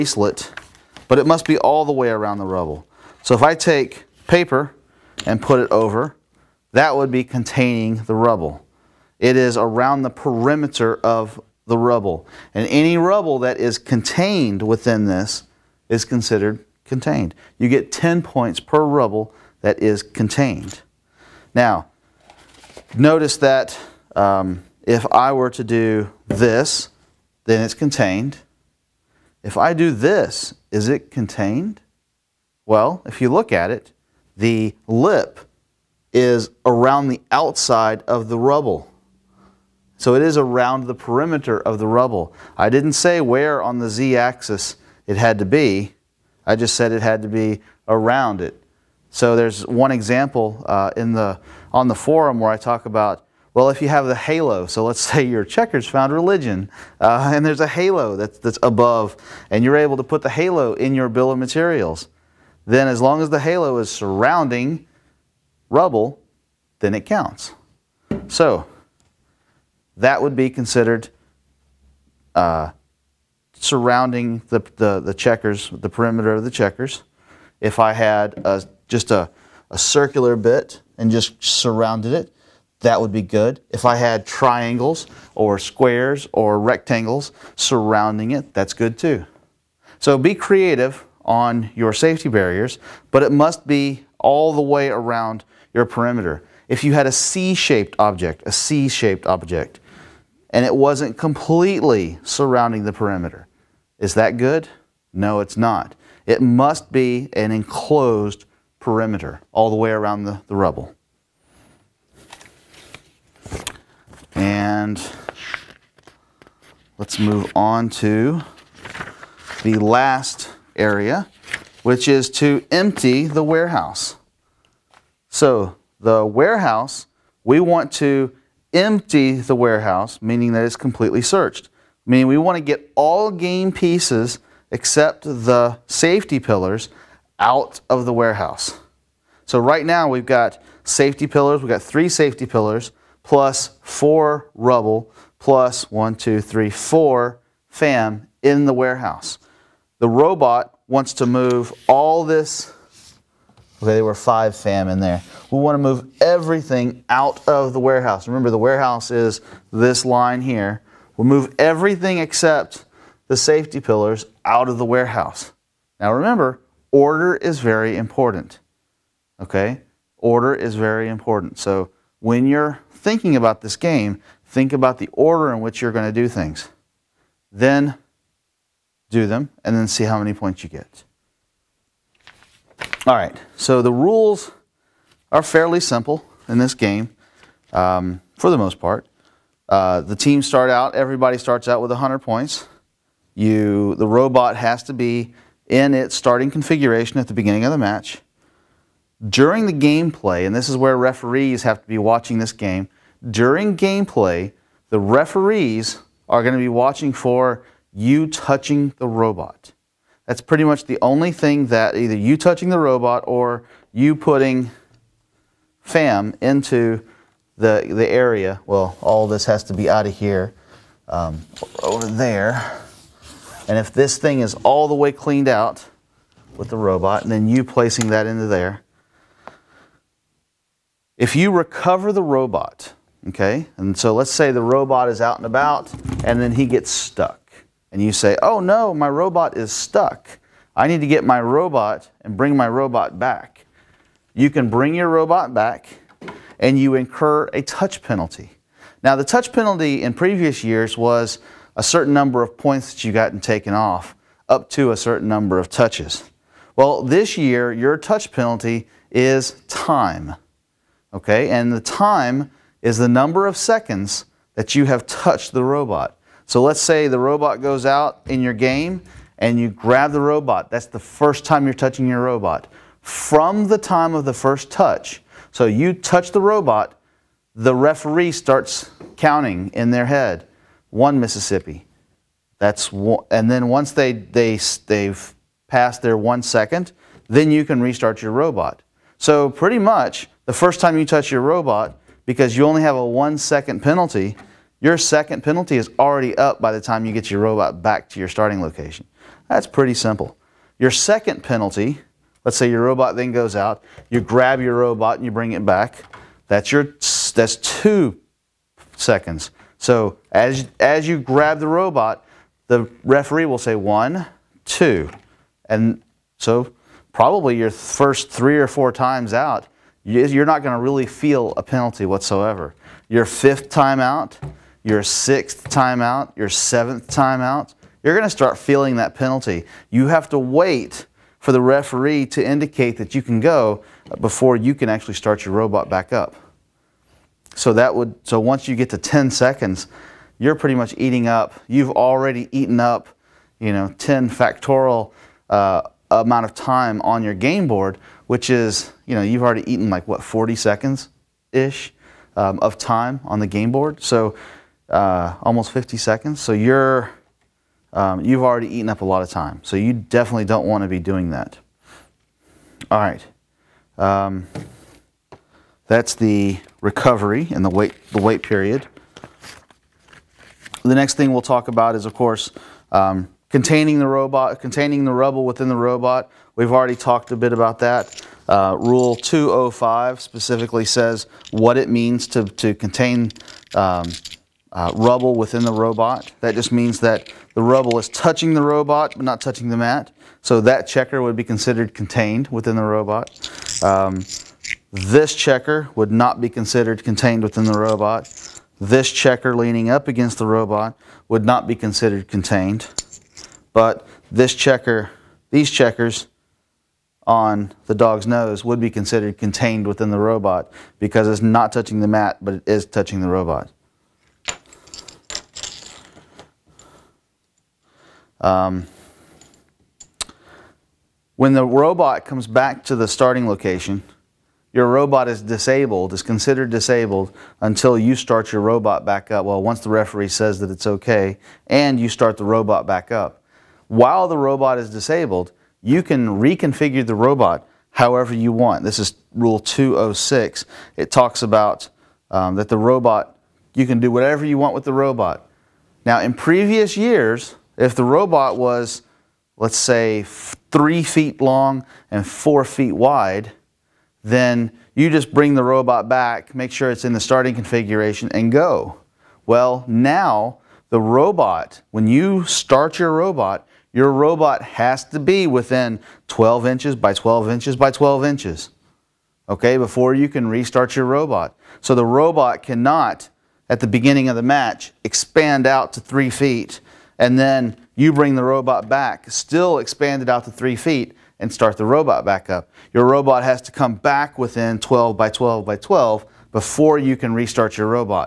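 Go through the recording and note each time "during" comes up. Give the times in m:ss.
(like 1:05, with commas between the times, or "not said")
3:19, 3:23.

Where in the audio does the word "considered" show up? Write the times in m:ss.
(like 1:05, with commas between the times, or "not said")
0:16, 1:10, 6:31, 6:36, 6:41, 6:48, 7:06.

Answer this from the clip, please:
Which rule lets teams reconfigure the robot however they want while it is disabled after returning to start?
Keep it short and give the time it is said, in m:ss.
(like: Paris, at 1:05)
206, at 7:19.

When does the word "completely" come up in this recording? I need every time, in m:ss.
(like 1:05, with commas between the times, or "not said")
1:41, 2:10.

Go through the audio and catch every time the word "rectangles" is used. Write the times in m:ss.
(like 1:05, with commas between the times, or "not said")
1:26.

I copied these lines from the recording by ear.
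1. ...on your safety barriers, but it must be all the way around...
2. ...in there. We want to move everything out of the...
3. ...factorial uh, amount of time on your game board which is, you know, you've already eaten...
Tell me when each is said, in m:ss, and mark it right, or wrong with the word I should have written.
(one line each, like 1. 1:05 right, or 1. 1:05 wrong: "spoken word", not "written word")
1. 1:31 right
2. 2:34 right
3. 5:44 right.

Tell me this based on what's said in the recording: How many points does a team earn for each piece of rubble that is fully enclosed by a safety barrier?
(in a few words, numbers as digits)
10.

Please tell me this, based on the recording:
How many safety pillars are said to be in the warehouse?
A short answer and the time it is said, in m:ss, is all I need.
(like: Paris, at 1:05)
3, at 2:21.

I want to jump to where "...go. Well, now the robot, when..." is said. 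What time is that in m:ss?
7:38.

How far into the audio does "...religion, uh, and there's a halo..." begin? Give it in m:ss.
0:56.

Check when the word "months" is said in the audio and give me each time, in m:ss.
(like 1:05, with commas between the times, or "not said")
not said.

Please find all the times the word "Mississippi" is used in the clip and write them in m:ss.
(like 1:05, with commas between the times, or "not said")
4:41.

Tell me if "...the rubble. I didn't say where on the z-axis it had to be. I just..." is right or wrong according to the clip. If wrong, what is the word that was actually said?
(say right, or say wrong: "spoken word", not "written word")
right.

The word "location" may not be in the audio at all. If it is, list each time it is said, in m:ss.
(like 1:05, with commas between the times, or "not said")
4:58, 7:03.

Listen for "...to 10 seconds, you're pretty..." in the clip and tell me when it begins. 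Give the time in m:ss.
5:38.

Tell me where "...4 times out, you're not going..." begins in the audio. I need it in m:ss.
5:18.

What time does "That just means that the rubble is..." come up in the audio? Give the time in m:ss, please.
6:26.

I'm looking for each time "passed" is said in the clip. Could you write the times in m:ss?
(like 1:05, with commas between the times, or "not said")
4:45.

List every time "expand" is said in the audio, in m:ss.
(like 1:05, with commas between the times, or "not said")
7:55, 7:59.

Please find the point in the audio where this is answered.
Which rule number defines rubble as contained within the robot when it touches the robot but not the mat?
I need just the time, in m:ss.
6:18.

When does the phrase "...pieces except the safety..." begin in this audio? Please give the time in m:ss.
2:13.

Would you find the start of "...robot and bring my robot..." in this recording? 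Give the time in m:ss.
4:01.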